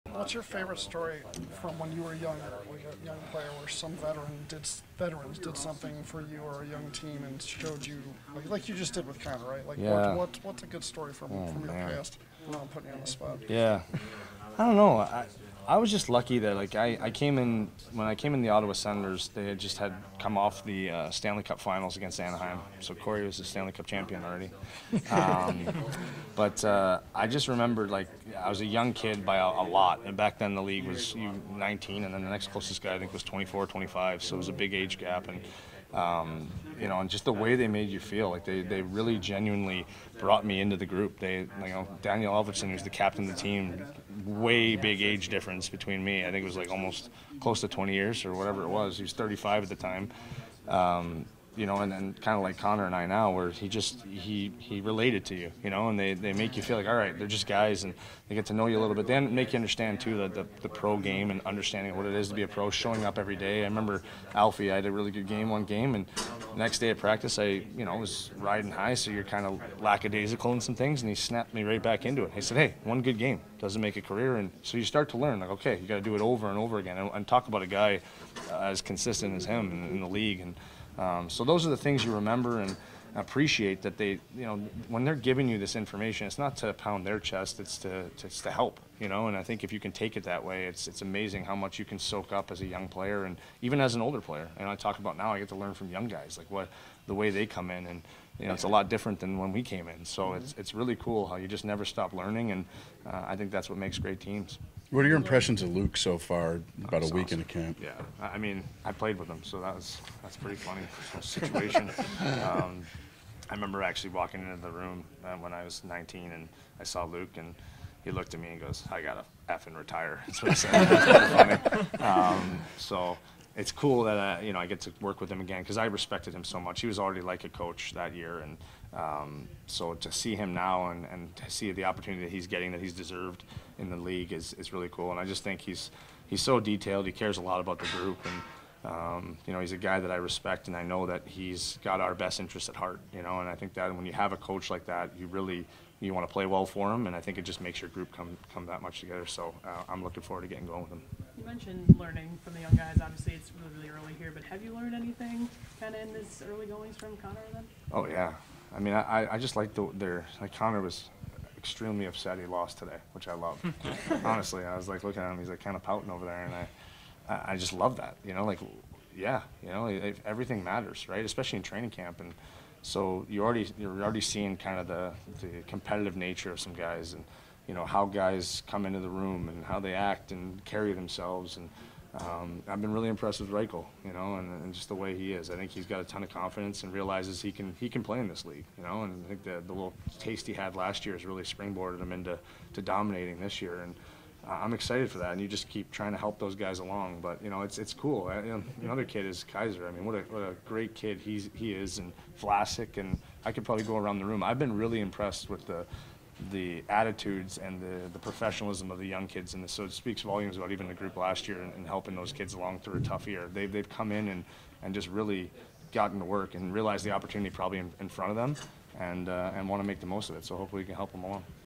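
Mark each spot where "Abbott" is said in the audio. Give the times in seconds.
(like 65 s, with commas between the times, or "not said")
not said.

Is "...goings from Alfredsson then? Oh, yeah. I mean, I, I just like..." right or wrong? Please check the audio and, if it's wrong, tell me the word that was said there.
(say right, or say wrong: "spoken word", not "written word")
wrong: "Connor", not "Alfredsson".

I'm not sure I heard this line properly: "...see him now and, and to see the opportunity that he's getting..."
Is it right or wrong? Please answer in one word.
right.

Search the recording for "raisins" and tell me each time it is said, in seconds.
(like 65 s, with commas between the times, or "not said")
not said.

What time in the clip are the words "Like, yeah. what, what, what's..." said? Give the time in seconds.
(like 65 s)
9 s.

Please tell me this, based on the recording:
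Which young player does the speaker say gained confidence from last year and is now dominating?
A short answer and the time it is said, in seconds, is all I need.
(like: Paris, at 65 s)
Reichel, at 183 s.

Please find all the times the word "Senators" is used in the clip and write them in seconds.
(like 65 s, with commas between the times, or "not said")
18 s.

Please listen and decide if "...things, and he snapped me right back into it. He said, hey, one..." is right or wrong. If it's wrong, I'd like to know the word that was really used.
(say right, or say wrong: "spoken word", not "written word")
right.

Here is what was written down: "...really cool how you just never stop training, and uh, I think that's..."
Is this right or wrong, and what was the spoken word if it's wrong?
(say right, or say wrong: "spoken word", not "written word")
wrong: "learning", not "training".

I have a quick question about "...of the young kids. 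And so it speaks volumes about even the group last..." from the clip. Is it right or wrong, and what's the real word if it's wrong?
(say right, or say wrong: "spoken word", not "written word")
right.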